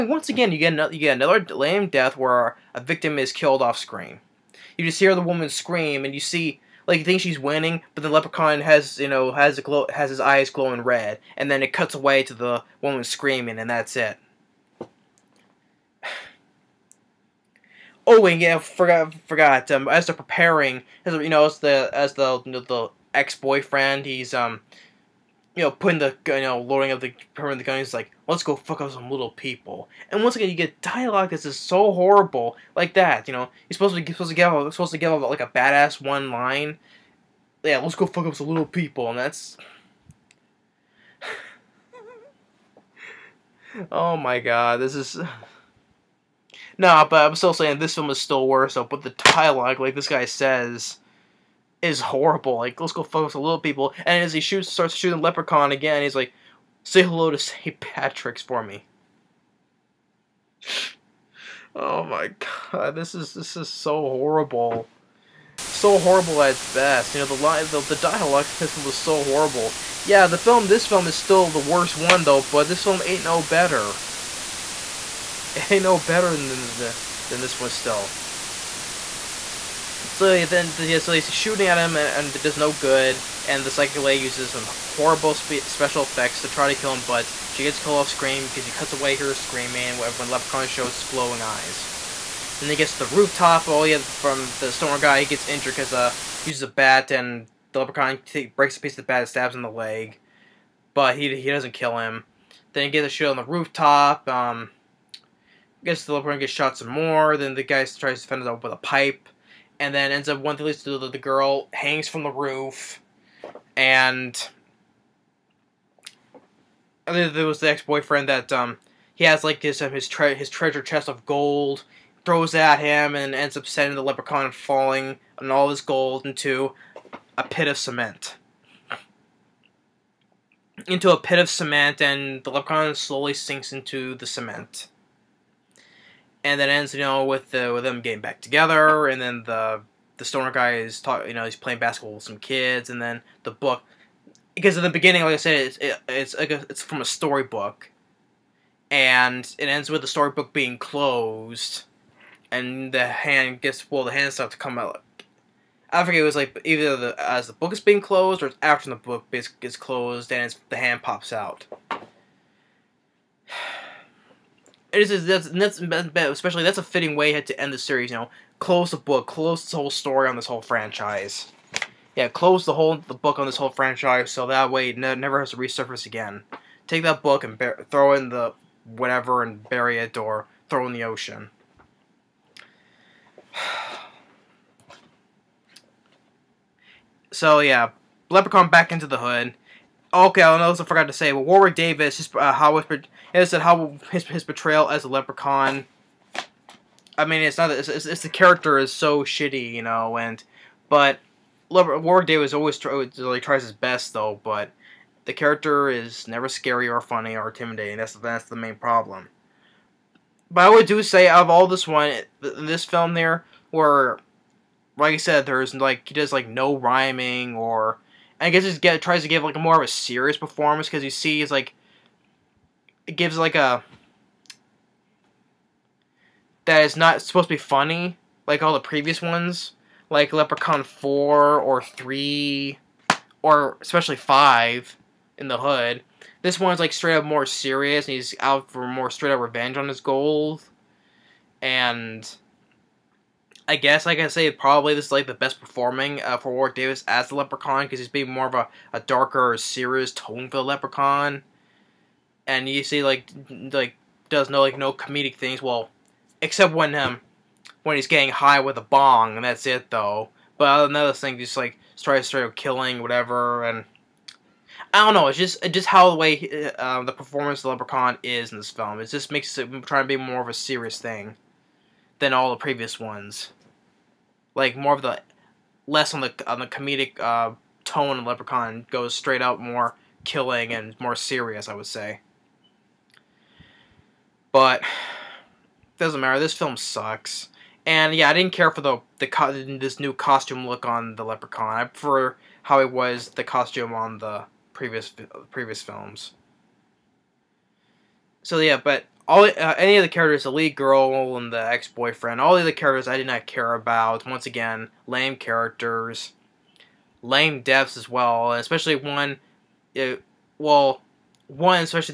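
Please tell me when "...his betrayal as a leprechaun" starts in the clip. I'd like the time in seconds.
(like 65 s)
194 s.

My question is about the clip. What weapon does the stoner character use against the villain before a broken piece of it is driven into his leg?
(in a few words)
a bat.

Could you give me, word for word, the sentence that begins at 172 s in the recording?
Yeah, close the whole the book on this whole franchise, so that way it never has to resurface again.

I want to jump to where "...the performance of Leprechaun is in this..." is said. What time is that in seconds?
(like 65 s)
267 s.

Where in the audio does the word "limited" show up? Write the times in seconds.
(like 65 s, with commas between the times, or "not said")
not said.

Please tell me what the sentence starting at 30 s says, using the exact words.
And once again, you get dialogue that's just so horrible, like that.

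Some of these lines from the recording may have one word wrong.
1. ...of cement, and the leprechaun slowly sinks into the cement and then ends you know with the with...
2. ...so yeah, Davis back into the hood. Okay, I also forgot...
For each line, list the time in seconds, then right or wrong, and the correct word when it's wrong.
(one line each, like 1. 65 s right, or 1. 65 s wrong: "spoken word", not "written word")
1. 131 s right
2. 187 s wrong: "Leprechaun", not "Davis".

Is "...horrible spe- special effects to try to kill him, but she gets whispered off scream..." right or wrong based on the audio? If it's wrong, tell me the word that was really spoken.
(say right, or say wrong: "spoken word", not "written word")
wrong: "killed", not "whispered".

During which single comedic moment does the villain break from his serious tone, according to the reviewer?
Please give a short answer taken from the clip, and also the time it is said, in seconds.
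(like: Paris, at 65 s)
getting high with a bong, at 258 s.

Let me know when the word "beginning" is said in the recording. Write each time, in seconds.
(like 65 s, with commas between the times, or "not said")
144 s.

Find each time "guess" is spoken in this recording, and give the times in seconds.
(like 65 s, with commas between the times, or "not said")
218 s, 243 s.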